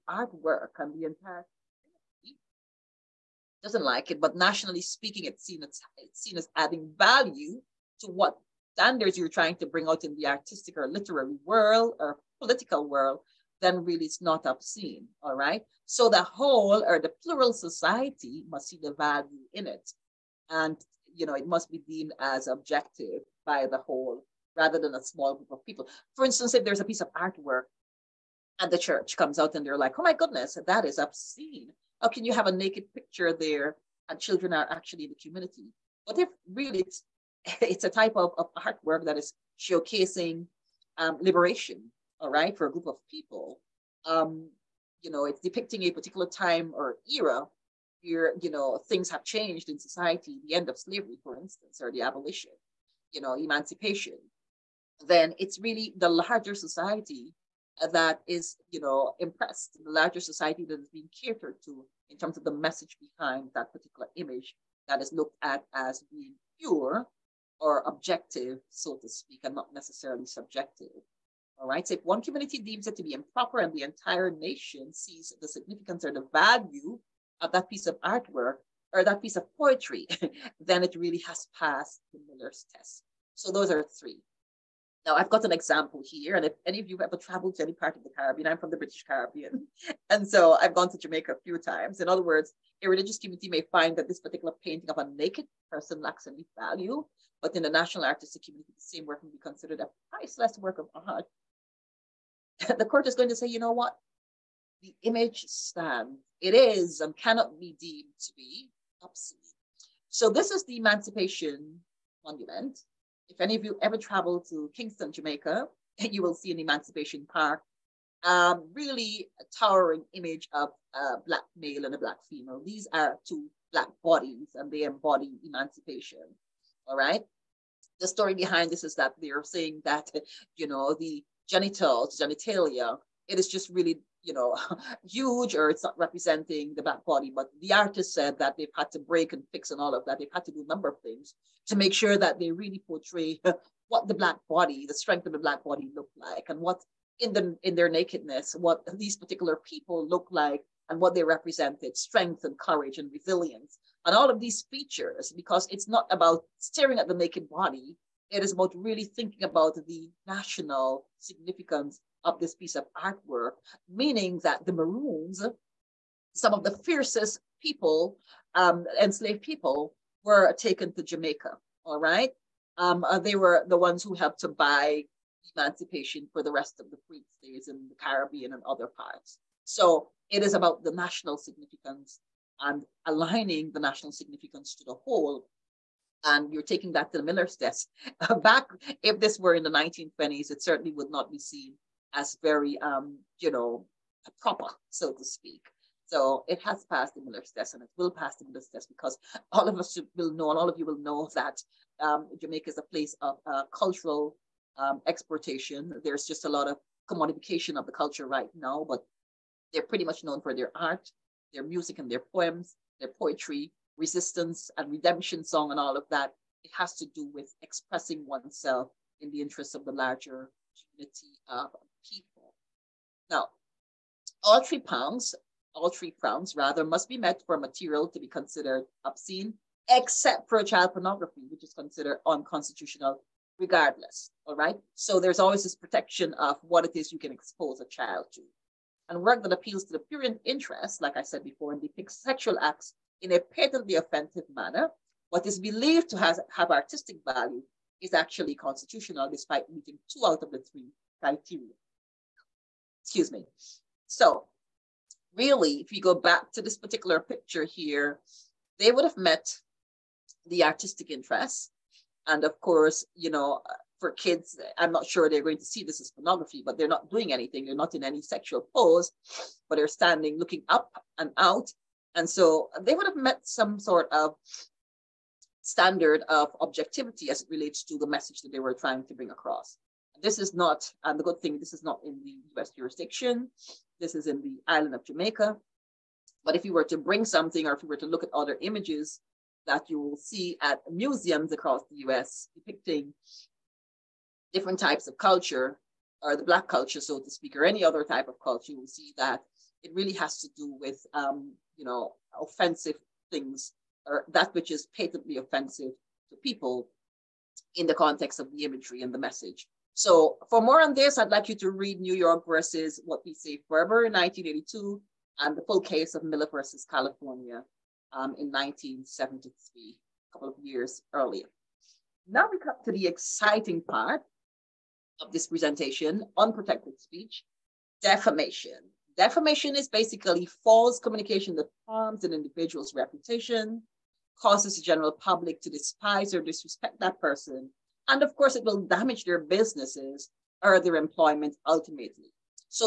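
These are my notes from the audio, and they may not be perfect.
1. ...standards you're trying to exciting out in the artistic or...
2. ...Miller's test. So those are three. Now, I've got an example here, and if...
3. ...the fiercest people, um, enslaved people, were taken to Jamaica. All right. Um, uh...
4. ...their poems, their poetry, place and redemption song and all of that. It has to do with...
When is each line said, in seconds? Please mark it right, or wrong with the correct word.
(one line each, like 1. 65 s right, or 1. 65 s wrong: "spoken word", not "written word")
1. 8 s wrong: "bring", not "exciting"
2. 82 s right
3. 166 s right
4. 212 s wrong: "resistance", not "place".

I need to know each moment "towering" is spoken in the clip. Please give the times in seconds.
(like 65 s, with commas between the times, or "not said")
119 s.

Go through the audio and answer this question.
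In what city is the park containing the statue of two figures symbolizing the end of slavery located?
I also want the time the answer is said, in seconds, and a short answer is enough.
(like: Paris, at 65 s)
Kingston, at 114 s.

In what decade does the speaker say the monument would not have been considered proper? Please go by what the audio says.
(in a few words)
1920s.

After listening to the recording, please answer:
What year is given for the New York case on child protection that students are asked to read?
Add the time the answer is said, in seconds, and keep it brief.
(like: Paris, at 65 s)
1982, at 314 s.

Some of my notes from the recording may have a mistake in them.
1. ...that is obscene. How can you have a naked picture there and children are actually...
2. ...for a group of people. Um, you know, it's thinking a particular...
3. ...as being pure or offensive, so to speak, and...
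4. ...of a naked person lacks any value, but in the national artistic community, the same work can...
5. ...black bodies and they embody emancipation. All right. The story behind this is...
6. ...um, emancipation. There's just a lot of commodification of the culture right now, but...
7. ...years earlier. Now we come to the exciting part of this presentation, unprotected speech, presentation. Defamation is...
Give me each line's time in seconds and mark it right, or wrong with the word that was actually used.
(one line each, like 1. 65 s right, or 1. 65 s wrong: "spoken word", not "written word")
1. 30 s right
2. 42 s wrong: "depicting", not "thinking"
3. 65 s wrong: "objective", not "offensive"
4. 94 s right
5. 123 s right
6. 204 s wrong: "exportation", not "emancipation"
7. 320 s wrong: "defamation", not "presentation".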